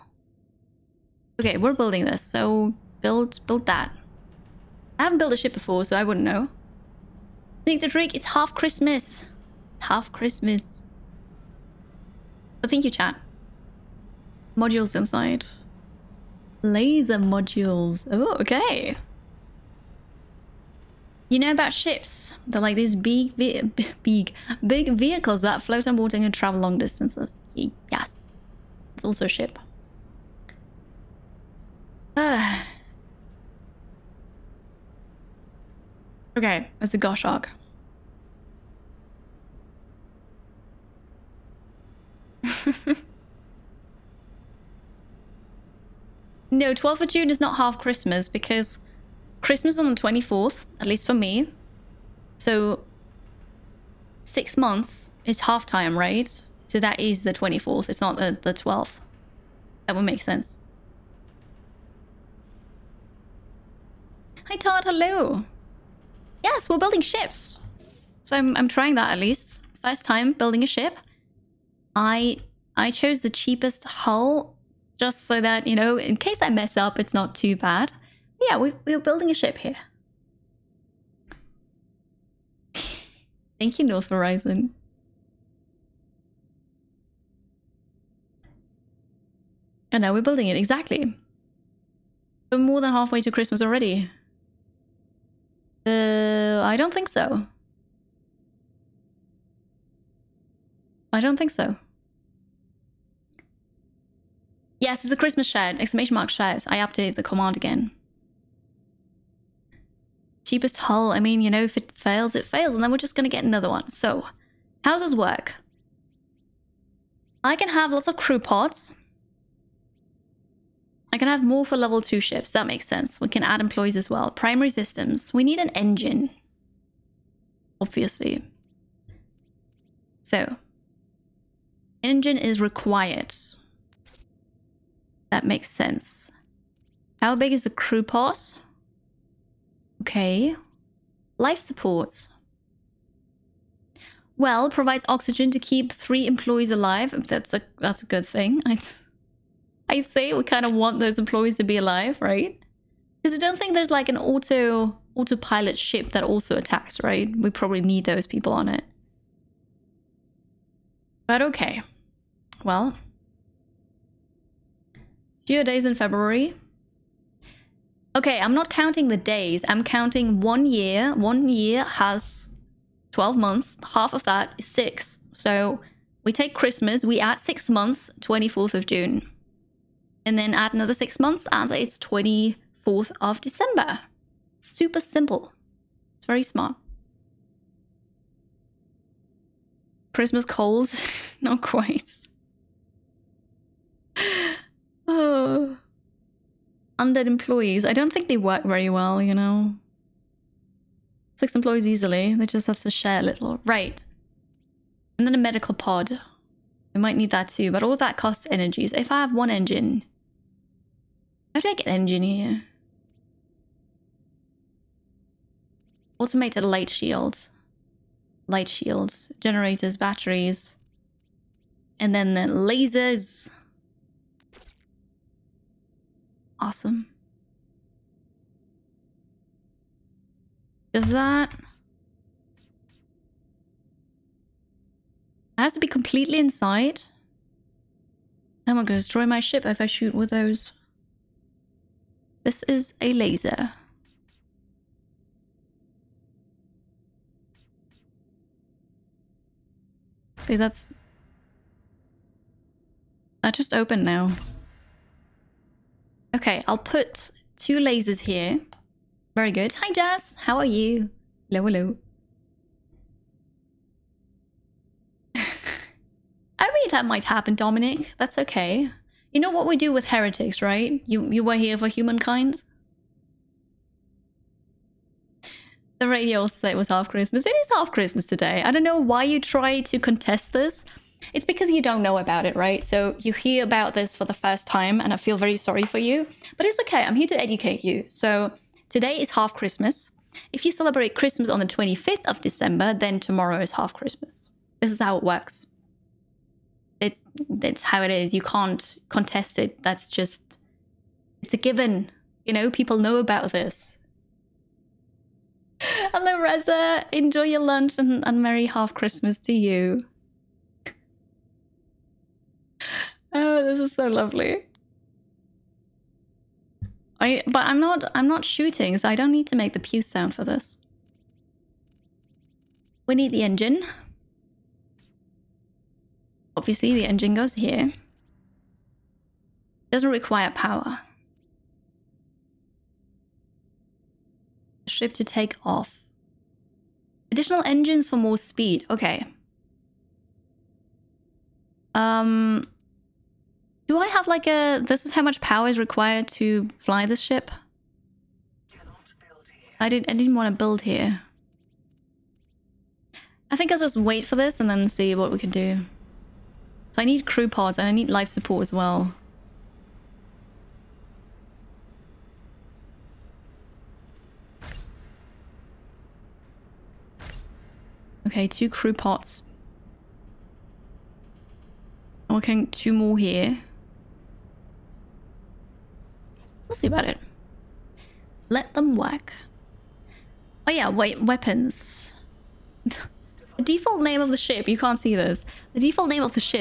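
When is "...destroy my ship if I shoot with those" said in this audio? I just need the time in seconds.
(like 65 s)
239 s.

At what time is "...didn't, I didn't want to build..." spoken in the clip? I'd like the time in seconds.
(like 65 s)
349 s.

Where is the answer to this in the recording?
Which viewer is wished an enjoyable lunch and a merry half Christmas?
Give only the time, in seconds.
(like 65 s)
306 s.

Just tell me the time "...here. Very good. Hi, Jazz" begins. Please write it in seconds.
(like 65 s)
258 s.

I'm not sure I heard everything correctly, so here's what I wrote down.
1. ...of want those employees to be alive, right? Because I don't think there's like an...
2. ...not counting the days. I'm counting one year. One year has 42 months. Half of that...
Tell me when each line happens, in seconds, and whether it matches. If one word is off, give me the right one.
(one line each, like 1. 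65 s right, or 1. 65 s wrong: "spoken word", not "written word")
1. 150 s right
2. 168 s wrong: "12", not "42".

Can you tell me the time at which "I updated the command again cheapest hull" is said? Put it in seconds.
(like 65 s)
106 s.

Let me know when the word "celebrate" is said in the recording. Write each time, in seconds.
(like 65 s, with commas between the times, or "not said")
290 s.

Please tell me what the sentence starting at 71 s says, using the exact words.
I I chose the cheapest hull just so that, you know, in case I mess up, it's not too bad.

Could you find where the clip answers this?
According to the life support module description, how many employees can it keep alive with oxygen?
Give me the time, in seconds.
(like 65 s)
145 s.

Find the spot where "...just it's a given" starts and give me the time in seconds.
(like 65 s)
300 s.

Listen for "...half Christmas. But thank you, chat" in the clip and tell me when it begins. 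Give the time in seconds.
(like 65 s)
9 s.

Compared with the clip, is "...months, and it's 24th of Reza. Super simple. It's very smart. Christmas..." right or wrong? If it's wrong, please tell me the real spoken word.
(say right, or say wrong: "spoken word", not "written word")
wrong: "December", not "Reza".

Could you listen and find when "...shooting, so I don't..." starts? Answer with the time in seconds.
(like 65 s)
318 s.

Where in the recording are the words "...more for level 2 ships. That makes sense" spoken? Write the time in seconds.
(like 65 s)
121 s.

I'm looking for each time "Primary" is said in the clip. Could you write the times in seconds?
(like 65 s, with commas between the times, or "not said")
124 s.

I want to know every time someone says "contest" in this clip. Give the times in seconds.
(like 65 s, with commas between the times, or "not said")
279 s, 299 s.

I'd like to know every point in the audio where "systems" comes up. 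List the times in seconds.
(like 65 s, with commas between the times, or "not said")
124 s.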